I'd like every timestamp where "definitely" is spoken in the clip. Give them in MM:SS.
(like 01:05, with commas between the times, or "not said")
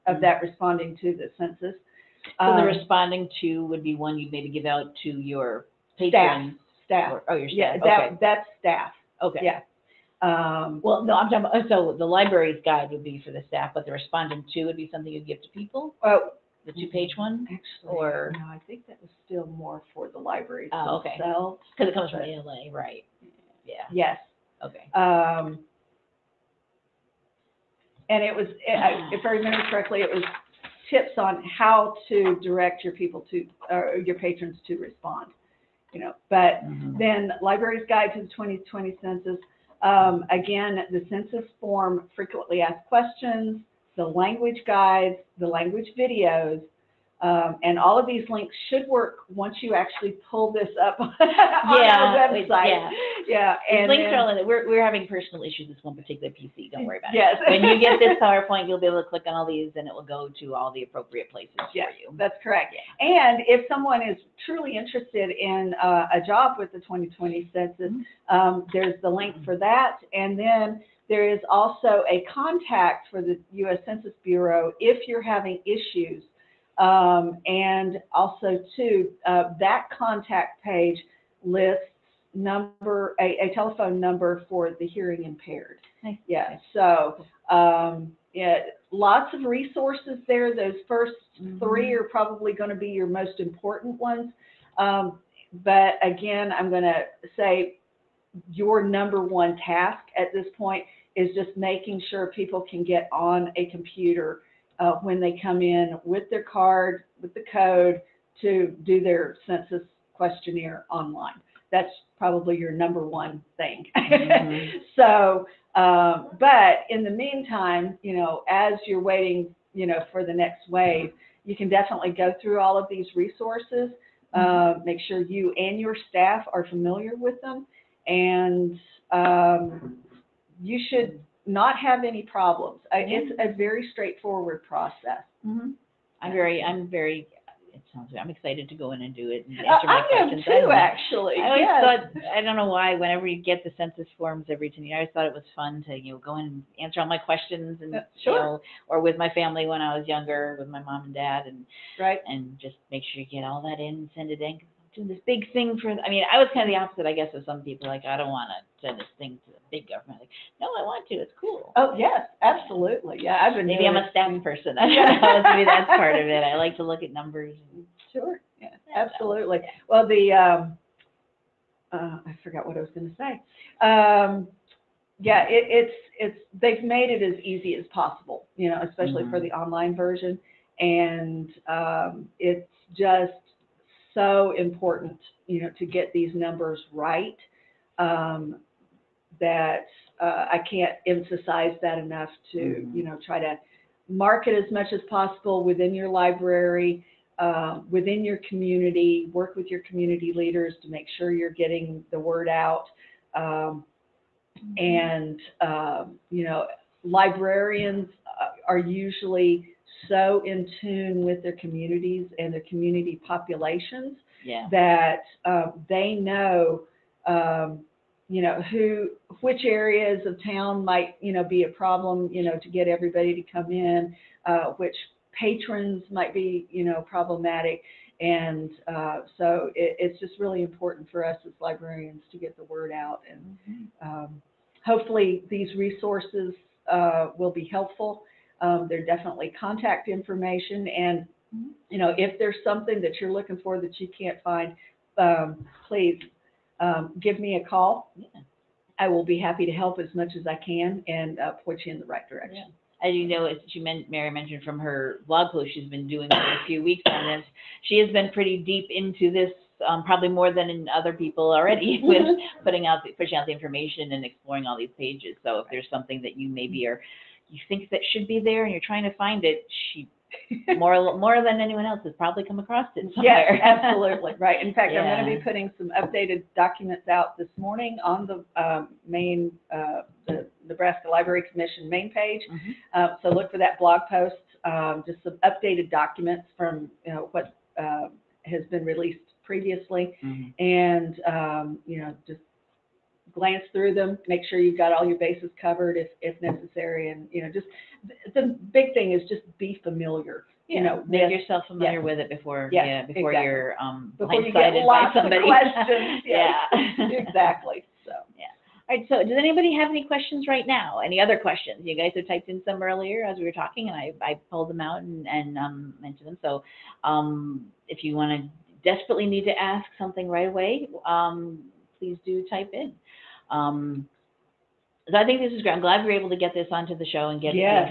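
02:01, 03:59.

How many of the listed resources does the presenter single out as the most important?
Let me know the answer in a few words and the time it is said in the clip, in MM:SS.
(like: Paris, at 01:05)
3, at 01:31.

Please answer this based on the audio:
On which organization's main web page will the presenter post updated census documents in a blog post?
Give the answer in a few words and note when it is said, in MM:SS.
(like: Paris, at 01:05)
Nebraska Library Commission, at 04:40.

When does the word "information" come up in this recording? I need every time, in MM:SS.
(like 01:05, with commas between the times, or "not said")
04:00, 04:23.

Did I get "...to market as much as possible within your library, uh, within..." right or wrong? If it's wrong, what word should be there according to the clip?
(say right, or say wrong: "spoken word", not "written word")
right.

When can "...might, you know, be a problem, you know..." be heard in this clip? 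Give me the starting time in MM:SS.
03:40.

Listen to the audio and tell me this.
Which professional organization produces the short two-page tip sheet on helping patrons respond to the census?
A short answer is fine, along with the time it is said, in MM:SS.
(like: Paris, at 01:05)
ALA, at 00:22.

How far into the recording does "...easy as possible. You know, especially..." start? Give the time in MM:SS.
02:57.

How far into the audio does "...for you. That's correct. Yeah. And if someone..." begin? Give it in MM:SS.
01:01.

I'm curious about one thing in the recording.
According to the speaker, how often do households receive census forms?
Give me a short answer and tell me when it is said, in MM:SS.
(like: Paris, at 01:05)
every 10 years, at 02:24.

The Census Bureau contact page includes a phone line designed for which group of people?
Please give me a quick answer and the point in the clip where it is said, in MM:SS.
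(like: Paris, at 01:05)
the hearing impaired, at 01:24.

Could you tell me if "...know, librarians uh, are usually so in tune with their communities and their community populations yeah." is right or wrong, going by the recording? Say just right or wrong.
right.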